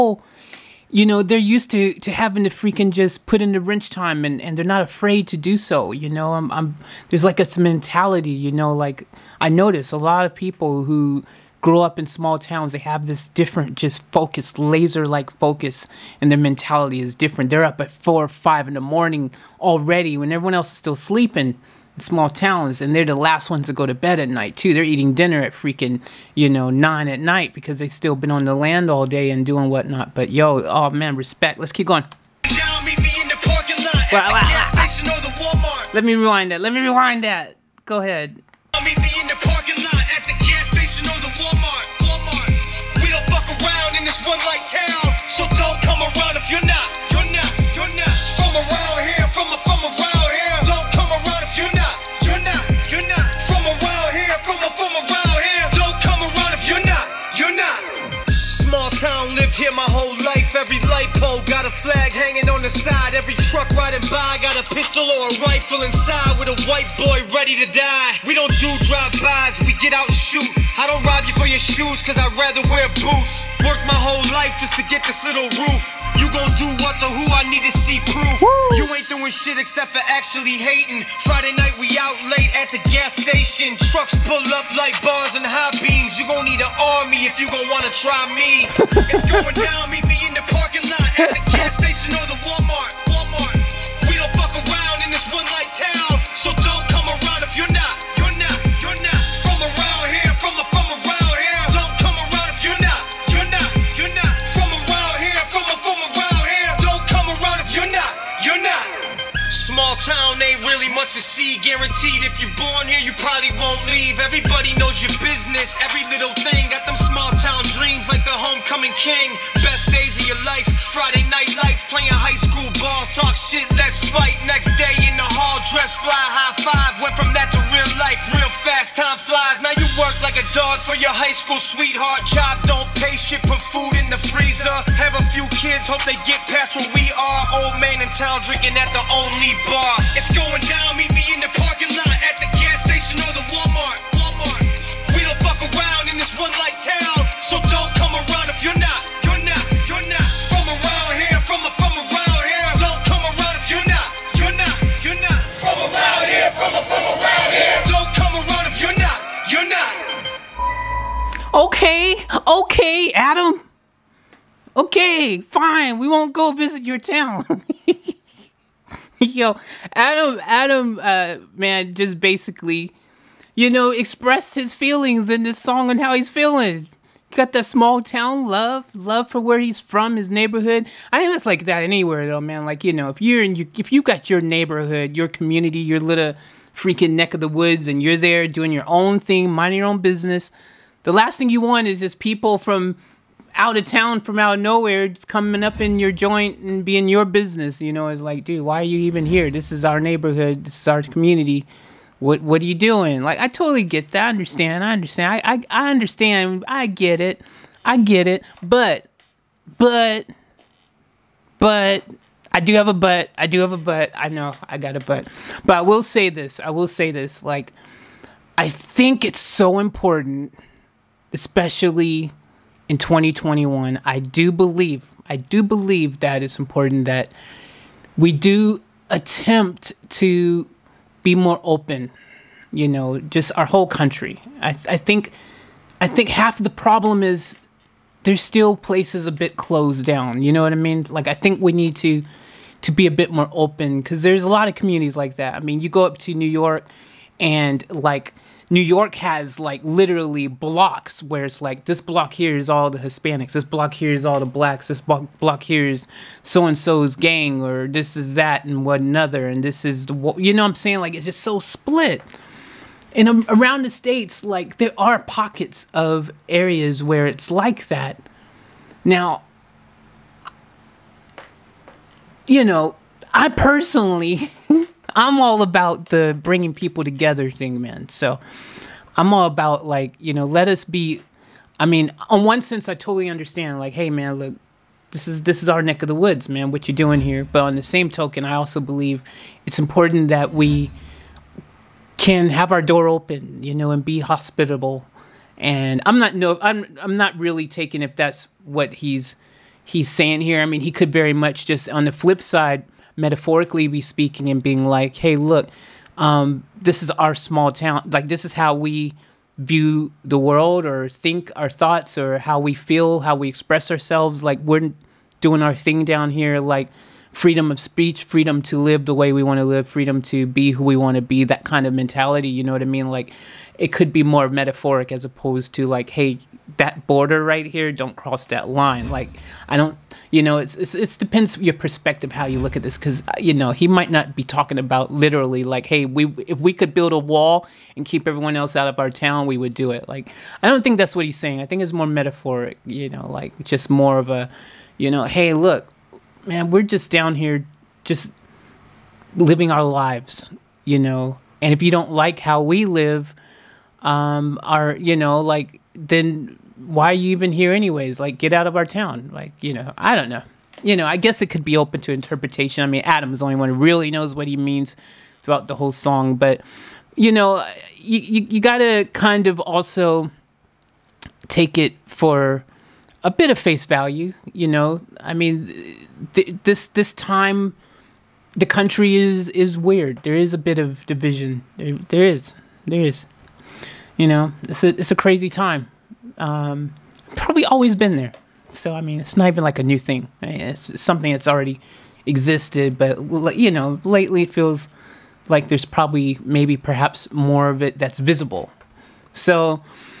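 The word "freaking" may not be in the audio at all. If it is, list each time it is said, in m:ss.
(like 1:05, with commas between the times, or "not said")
0:02, 0:25, 3:06.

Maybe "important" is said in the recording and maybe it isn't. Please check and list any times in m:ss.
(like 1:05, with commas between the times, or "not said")
3:39, 3:46, 4:49.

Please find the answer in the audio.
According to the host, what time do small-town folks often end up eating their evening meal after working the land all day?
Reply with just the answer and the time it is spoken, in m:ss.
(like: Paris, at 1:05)
9 at night, at 0:26.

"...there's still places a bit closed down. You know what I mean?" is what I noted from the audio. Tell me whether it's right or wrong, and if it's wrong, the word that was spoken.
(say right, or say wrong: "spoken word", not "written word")
right.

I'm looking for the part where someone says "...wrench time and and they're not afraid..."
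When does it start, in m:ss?
0:03.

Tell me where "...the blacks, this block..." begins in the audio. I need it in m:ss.
4:14.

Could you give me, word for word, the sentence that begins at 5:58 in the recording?
Like, get out of our town.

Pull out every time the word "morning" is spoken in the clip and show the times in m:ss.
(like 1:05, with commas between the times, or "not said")
0:18.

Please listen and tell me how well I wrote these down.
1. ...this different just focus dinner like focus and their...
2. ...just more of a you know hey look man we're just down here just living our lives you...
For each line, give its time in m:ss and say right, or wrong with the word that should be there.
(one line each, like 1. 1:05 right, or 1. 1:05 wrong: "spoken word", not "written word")
1. 0:13 wrong: "laser", not "dinner"
2. 5:43 right.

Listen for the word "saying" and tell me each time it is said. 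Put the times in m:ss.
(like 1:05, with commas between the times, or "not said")
4:20, 5:00, 5:41.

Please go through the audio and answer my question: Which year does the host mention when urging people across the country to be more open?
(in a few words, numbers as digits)
2021.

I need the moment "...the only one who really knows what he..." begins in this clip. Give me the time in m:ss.
6:03.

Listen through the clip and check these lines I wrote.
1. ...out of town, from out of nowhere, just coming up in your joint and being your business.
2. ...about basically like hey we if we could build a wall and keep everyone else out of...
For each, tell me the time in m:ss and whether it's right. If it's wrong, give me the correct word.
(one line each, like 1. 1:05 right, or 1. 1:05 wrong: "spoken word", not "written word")
1. 3:13 right
2. 5:34 wrong: "literally", not "basically".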